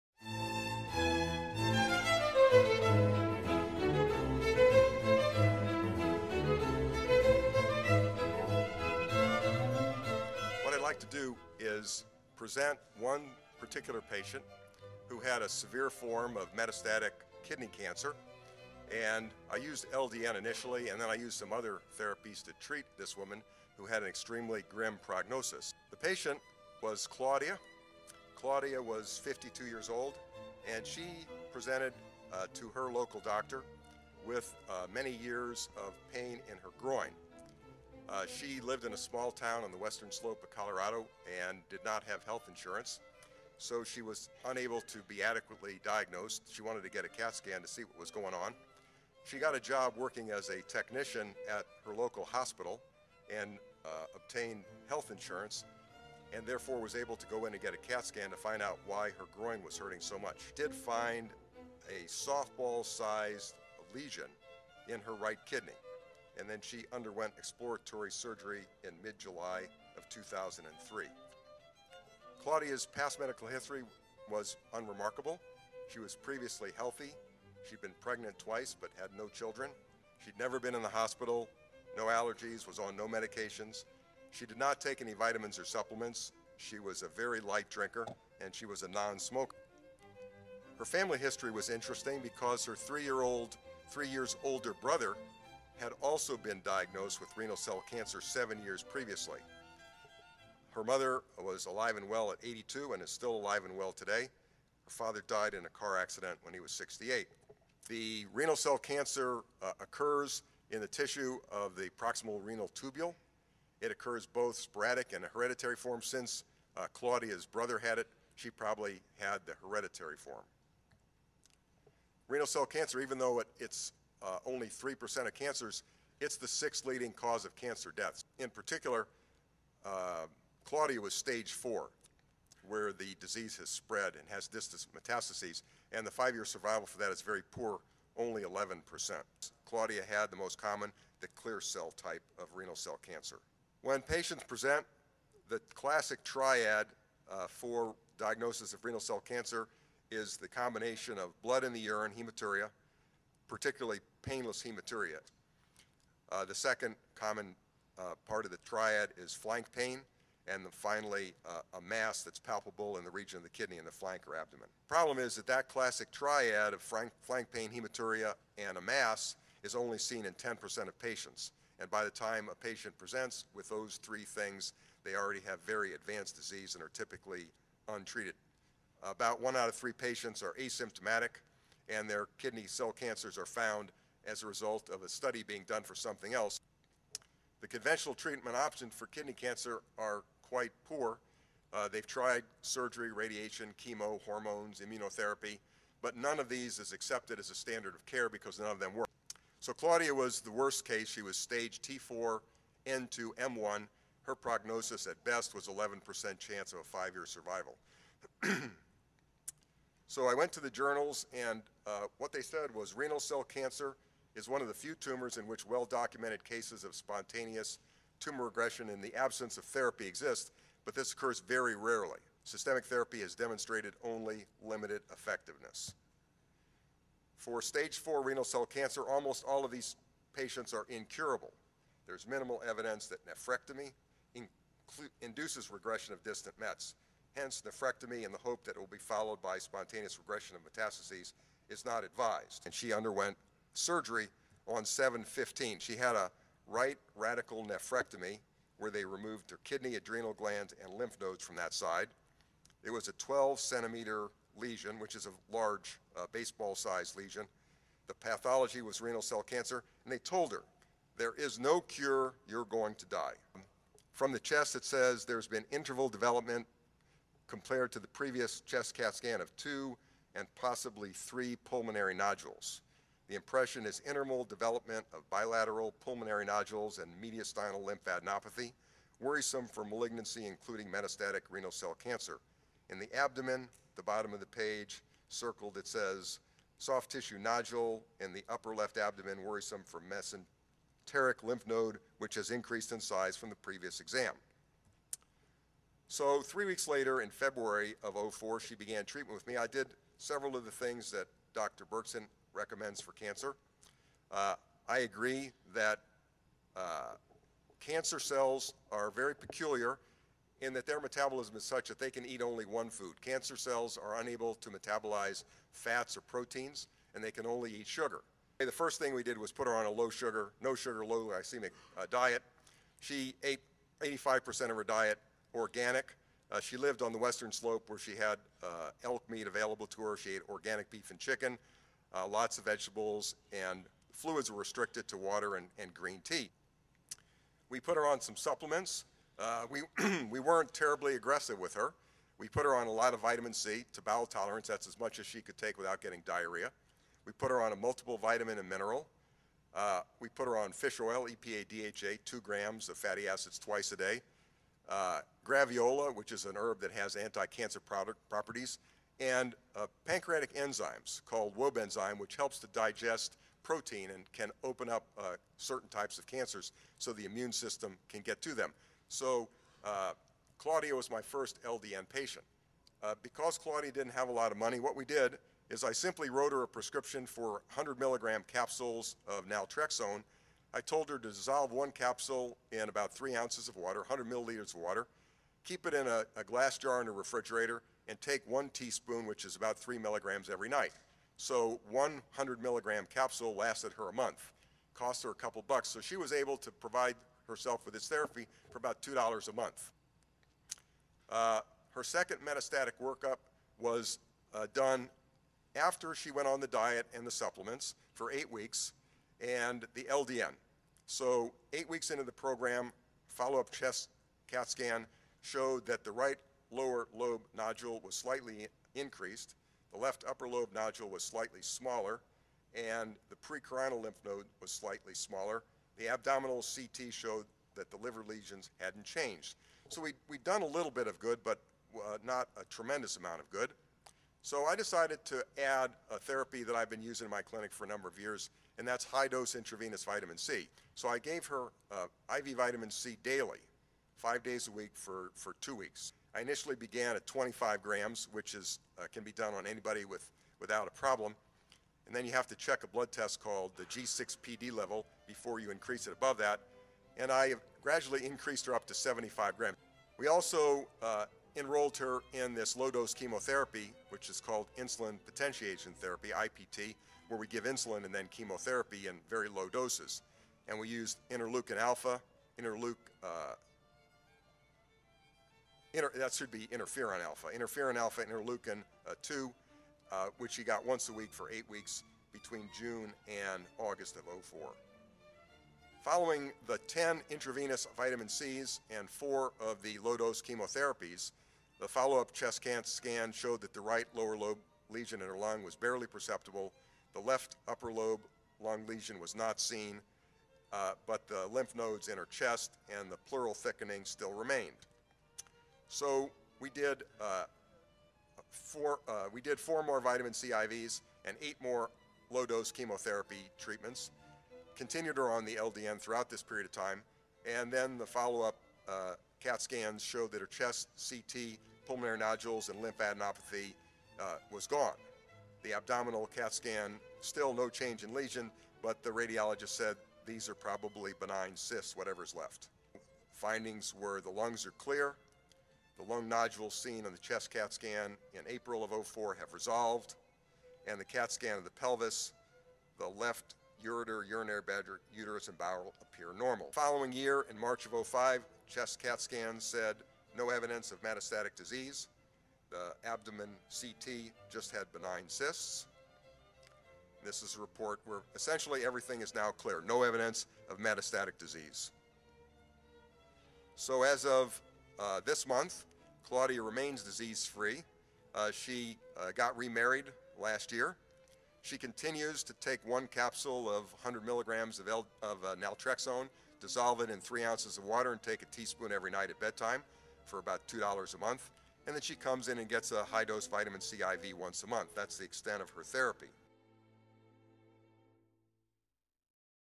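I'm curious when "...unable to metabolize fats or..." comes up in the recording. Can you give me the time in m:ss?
5:14.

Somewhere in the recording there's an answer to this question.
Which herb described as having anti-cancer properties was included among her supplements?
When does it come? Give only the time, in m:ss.
5:55.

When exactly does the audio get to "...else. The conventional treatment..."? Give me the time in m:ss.
3:06.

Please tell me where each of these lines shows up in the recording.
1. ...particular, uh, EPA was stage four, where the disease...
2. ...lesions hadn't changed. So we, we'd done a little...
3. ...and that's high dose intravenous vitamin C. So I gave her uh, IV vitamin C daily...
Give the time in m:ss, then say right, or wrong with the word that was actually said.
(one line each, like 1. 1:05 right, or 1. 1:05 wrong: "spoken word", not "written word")
1. 2:08 wrong: "Claudia", not "EPA"
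2. 7:08 right
3. 7:18 right.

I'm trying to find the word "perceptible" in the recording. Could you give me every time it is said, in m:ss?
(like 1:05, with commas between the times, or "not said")
8:16.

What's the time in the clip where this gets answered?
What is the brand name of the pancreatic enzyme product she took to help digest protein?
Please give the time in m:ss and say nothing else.
6:01.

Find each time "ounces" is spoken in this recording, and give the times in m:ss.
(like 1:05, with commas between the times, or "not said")
6:23, 9:37.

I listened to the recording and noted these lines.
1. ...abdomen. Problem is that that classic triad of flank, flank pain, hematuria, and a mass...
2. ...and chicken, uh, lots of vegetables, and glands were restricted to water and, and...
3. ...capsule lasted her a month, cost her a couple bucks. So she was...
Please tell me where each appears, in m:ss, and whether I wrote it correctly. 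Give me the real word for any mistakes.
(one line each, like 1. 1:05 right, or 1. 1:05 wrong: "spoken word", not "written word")
1. 2:44 right
2. 5:31 wrong: "fluids", not "glands"
3. 6:33 right.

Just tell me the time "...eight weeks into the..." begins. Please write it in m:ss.
6:51.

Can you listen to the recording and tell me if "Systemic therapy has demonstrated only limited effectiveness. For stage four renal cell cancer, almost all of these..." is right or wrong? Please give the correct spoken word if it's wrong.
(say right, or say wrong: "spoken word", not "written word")
right.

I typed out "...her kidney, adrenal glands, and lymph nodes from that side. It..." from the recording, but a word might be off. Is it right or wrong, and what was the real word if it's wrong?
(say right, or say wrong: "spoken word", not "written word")
right.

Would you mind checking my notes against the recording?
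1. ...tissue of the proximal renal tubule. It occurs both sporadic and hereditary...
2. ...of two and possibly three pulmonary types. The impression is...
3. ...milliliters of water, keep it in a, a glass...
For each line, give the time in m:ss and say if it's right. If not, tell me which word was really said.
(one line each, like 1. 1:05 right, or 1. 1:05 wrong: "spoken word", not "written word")
1. 1:50 right
2. 4:29 wrong: "nodules", not "types"
3. 6:24 right.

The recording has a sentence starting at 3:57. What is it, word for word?
Hence, nephrectomy in the hope that it will be followed by spontaneous regression of metastases is not advised.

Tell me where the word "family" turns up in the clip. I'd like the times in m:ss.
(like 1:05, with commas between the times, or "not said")
1:30.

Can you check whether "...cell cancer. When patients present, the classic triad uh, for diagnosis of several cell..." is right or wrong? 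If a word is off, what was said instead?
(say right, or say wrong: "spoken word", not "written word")
wrong: "renal", not "several".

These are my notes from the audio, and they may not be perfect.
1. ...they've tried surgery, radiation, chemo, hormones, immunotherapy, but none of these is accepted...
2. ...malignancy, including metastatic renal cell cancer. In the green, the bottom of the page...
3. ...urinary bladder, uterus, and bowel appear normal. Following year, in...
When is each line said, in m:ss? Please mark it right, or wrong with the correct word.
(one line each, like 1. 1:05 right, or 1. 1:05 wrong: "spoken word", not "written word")
1. 3:11 right
2. 4:39 wrong: "abdomen", not "green"
3. 9:04 right.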